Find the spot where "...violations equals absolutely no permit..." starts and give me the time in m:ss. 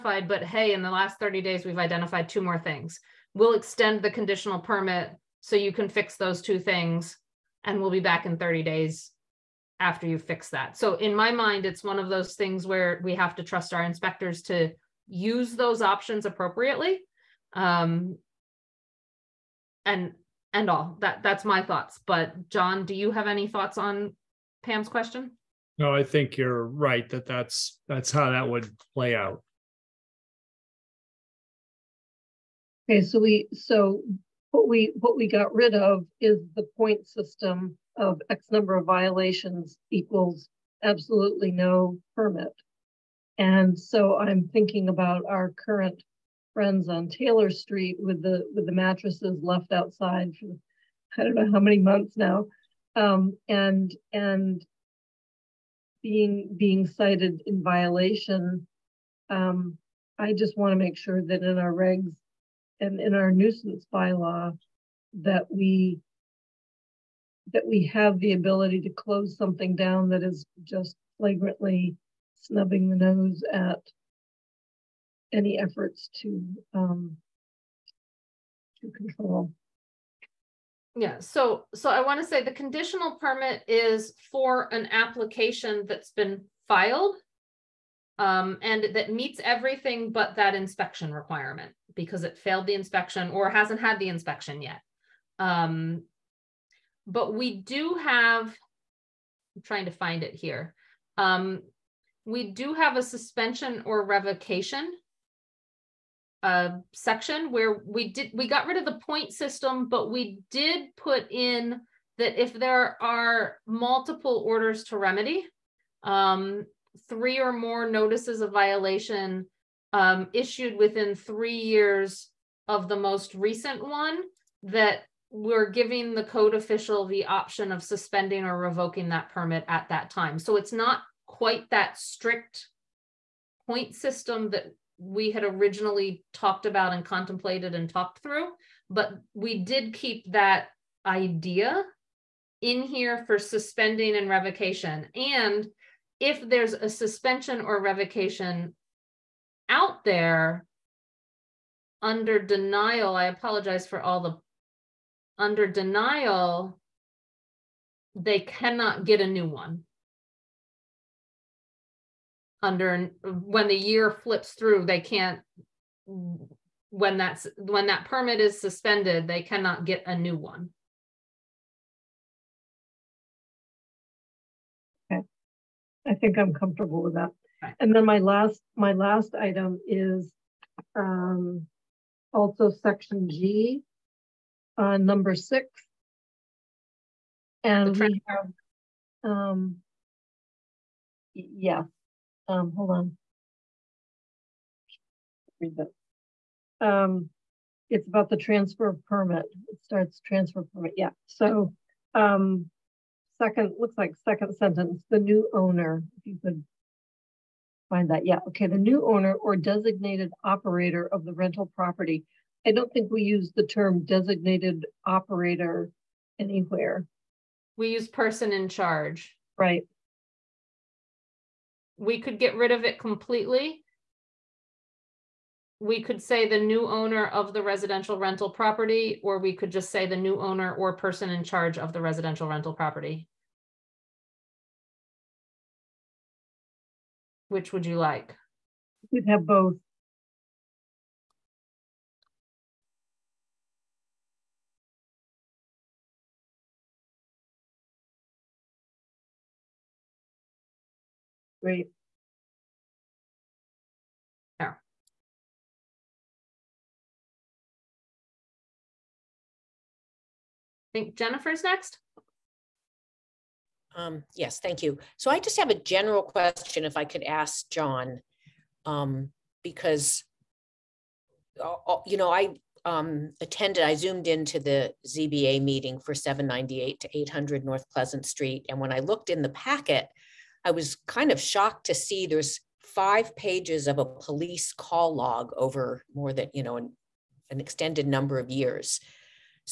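0:38.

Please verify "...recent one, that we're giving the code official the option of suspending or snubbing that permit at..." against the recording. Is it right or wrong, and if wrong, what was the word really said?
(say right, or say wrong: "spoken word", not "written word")
wrong: "revoking", not "snubbing".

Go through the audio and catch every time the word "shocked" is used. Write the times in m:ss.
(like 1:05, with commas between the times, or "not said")
4:41.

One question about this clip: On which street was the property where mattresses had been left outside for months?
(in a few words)
Taylor Street.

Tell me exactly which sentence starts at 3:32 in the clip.
I don't think we use the term designated operator anywhere.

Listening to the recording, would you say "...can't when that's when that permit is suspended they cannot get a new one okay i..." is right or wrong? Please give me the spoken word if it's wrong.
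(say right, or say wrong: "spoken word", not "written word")
right.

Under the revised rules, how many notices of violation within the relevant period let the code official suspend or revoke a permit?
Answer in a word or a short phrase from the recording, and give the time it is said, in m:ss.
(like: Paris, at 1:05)
3 or more, at 1:57.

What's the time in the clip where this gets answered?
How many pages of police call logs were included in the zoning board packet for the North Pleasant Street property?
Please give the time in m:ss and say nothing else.
4:42.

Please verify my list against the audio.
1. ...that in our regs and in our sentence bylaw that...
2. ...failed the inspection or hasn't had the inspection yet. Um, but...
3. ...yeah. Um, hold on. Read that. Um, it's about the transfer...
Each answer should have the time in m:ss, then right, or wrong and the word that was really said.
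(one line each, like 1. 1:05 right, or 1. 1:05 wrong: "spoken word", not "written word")
1. 1:01 wrong: "nuisance", not "sentence"
2. 1:32 right
3. 3:11 right.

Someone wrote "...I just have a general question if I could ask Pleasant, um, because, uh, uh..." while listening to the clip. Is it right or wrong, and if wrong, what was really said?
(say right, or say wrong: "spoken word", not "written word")
wrong: "John", not "Pleasant".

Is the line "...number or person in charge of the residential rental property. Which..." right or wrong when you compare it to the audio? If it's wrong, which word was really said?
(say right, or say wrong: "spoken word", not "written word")
wrong: "owner", not "number".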